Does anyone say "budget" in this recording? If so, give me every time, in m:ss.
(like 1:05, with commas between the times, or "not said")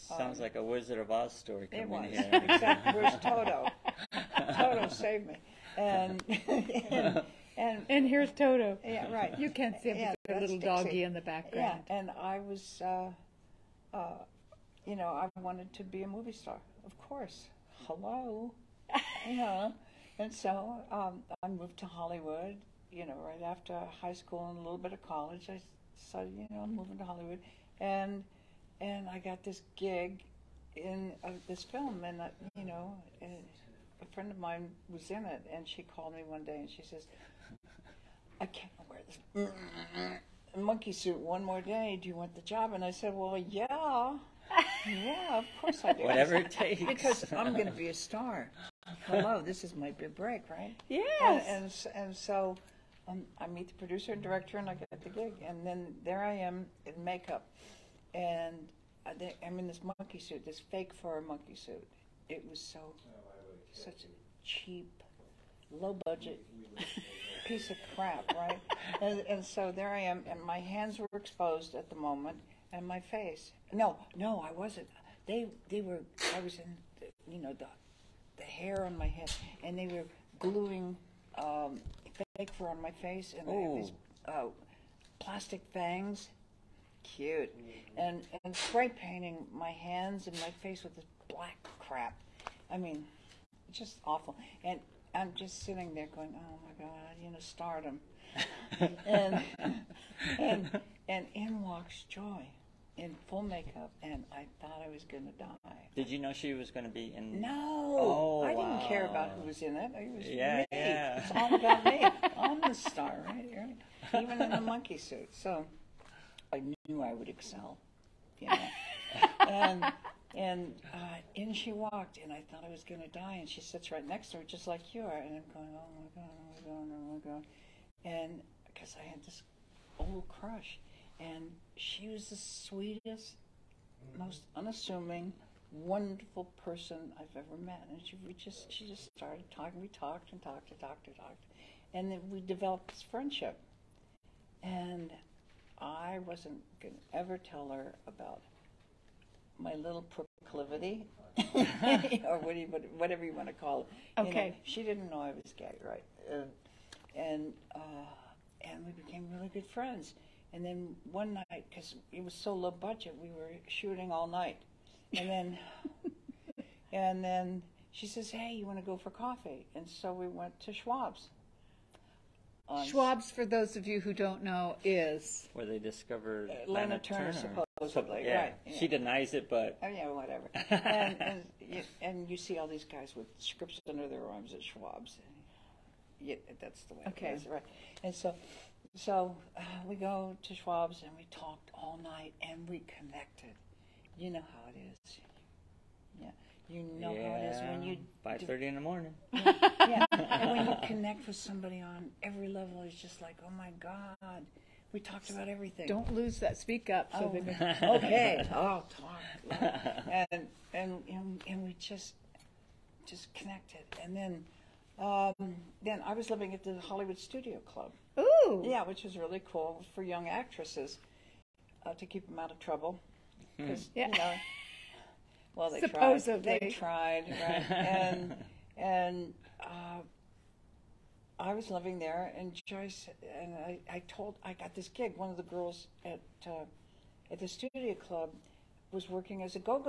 1:06, 2:42.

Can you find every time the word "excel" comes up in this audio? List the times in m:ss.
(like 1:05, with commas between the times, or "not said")
1:57.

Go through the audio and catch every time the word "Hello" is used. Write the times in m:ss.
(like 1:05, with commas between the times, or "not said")
0:17, 0:49.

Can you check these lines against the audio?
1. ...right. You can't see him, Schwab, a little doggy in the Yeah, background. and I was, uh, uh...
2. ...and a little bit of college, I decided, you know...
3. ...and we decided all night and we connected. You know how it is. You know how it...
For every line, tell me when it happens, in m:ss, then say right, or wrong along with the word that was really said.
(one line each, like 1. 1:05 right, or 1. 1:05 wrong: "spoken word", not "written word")
1. 0:09 wrong: "Yeah", not "Schwab"
2. 0:24 right
3. 3:11 wrong: "talked", not "decided".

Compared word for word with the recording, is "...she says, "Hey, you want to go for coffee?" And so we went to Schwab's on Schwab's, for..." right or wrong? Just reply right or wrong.
right.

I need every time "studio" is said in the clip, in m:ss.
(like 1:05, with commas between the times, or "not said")
3:37, 3:57.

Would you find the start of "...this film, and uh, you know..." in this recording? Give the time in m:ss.
0:31.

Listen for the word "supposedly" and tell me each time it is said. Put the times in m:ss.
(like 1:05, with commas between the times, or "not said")
2:57, 3:45.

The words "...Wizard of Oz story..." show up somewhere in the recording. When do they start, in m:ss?
0:00.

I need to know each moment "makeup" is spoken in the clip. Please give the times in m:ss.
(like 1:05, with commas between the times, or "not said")
0:57, 1:43.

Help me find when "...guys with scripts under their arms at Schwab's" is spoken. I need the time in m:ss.
3:02.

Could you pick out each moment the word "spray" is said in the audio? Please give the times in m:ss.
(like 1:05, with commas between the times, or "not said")
1:28.